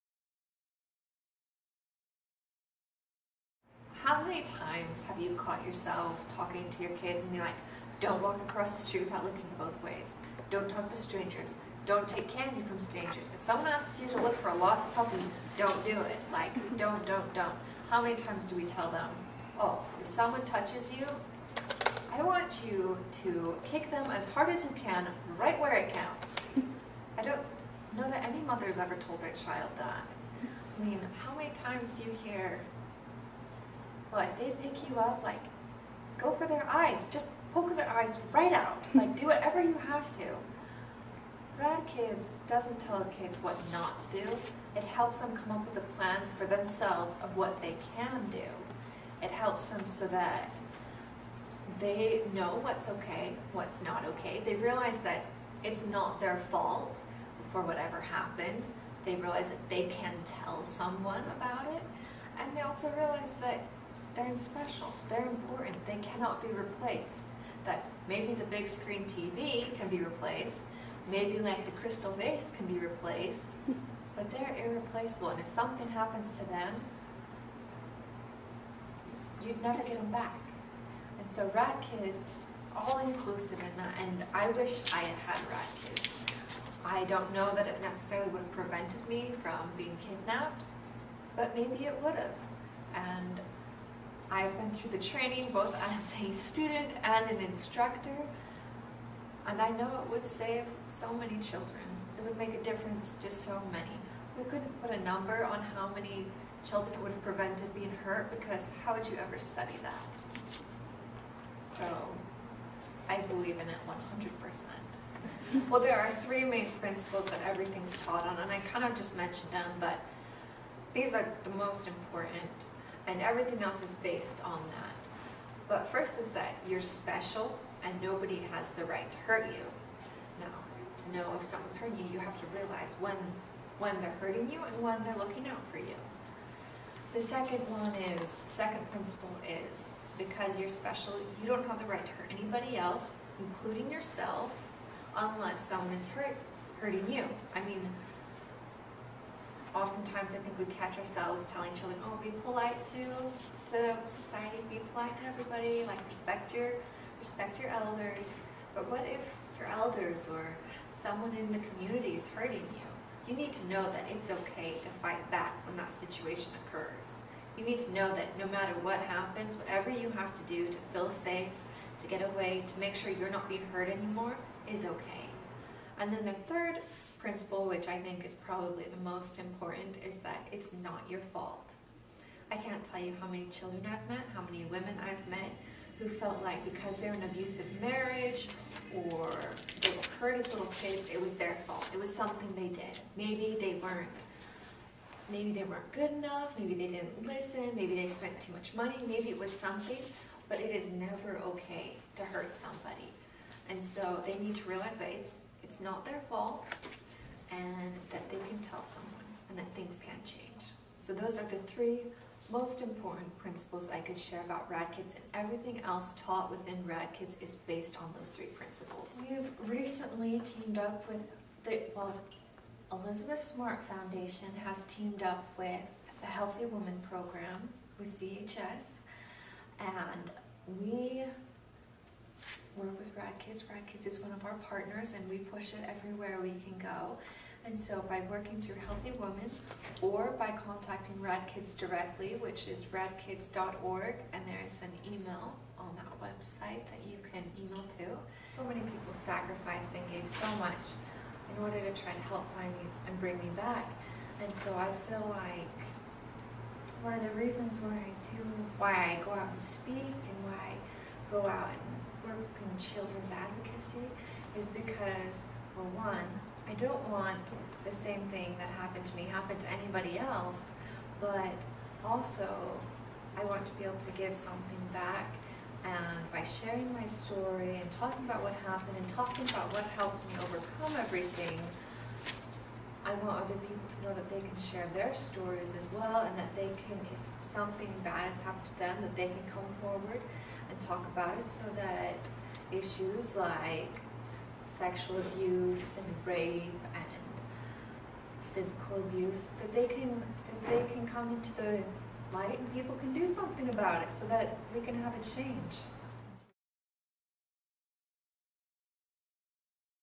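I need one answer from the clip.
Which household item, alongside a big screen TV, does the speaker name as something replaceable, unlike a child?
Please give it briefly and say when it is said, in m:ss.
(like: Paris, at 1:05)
crystal vase, at 1:11.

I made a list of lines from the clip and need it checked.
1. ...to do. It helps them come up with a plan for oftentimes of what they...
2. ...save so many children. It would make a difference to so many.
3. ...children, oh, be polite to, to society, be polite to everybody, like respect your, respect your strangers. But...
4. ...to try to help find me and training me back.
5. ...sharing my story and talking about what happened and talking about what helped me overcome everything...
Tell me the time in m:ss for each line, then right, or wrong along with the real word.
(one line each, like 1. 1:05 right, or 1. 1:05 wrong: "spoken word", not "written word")
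1. 0:44 wrong: "themselves", not "oftentimes"
2. 1:40 right
3. 2:31 wrong: "elders", not "strangers"
4. 4:11 wrong: "bring", not "training"
5. 4:36 right.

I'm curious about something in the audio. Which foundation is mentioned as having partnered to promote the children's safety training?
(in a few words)
Elizabeth Smart Foundation.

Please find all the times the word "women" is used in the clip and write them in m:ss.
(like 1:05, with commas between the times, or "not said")
3:04, 3:59.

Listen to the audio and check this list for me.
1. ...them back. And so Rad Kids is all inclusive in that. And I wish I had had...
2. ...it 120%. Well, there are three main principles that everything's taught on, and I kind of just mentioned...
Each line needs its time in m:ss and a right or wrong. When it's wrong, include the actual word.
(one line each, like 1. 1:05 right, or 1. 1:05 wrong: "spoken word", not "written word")
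1. 1:20 right
2. 1:53 wrong: "100", not "120".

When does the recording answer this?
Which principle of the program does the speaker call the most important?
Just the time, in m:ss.
3:00.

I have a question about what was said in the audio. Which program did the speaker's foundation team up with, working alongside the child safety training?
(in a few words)
Healthy Woman Program.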